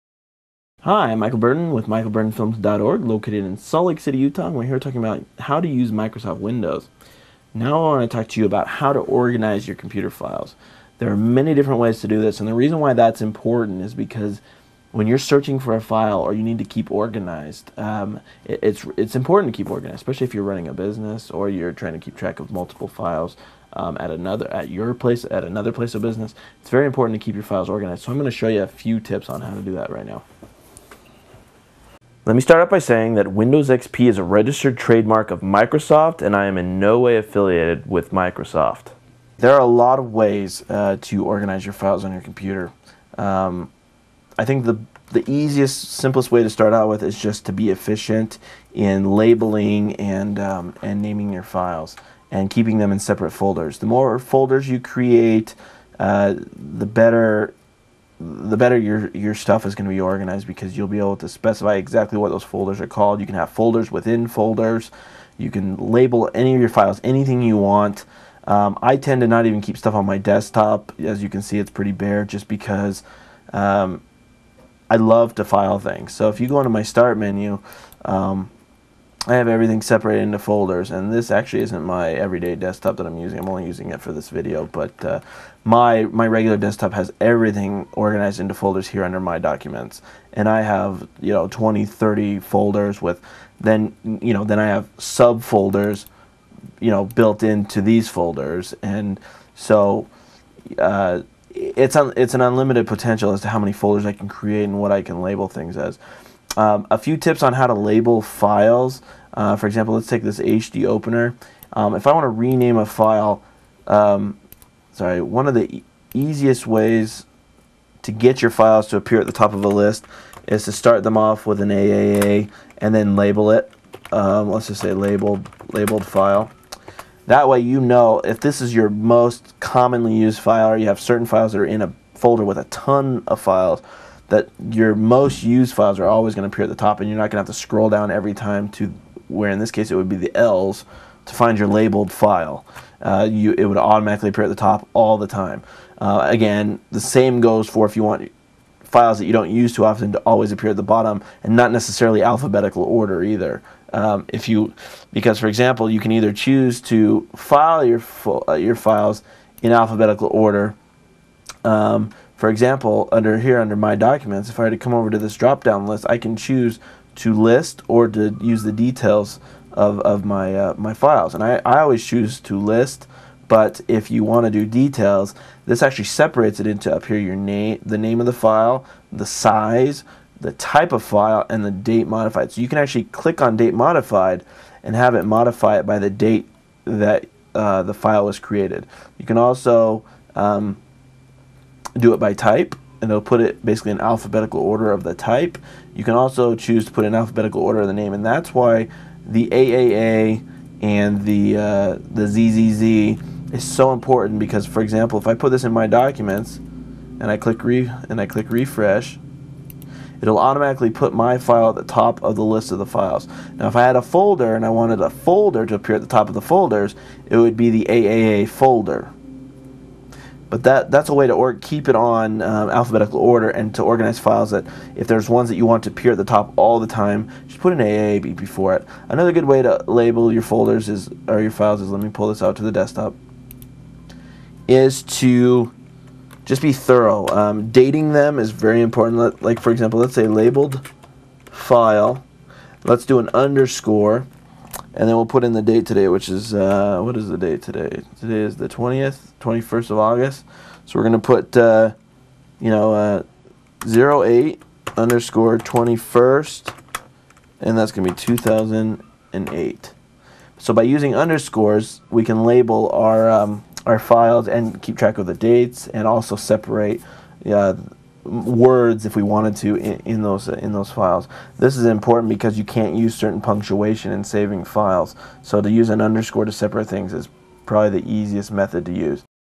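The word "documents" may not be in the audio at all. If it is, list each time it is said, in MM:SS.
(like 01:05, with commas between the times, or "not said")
01:29, 02:43, 03:25.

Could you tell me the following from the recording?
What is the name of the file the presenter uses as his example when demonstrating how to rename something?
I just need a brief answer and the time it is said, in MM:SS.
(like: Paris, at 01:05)
HD opener, at 01:50.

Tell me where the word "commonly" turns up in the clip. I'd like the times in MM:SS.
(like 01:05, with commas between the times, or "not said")
02:09.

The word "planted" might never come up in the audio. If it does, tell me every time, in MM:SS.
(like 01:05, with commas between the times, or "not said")
not said.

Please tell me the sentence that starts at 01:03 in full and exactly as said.
You can have folders within folders.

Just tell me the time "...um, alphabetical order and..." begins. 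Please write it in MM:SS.
03:42.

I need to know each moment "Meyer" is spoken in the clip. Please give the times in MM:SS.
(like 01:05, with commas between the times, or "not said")
not said.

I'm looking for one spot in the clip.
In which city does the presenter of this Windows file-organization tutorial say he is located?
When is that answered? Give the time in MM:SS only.
00:03.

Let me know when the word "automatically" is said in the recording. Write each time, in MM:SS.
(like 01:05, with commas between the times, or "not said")
02:23, 03:30.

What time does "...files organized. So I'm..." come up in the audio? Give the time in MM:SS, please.
00:27.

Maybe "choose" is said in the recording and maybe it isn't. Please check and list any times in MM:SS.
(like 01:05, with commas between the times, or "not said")
02:36, 02:46, 02:52, 03:16.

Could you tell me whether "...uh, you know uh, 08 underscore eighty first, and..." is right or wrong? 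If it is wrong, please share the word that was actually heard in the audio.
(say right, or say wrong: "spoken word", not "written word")
wrong: "twenty", not "eighty".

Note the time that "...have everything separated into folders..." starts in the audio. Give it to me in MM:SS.
01:19.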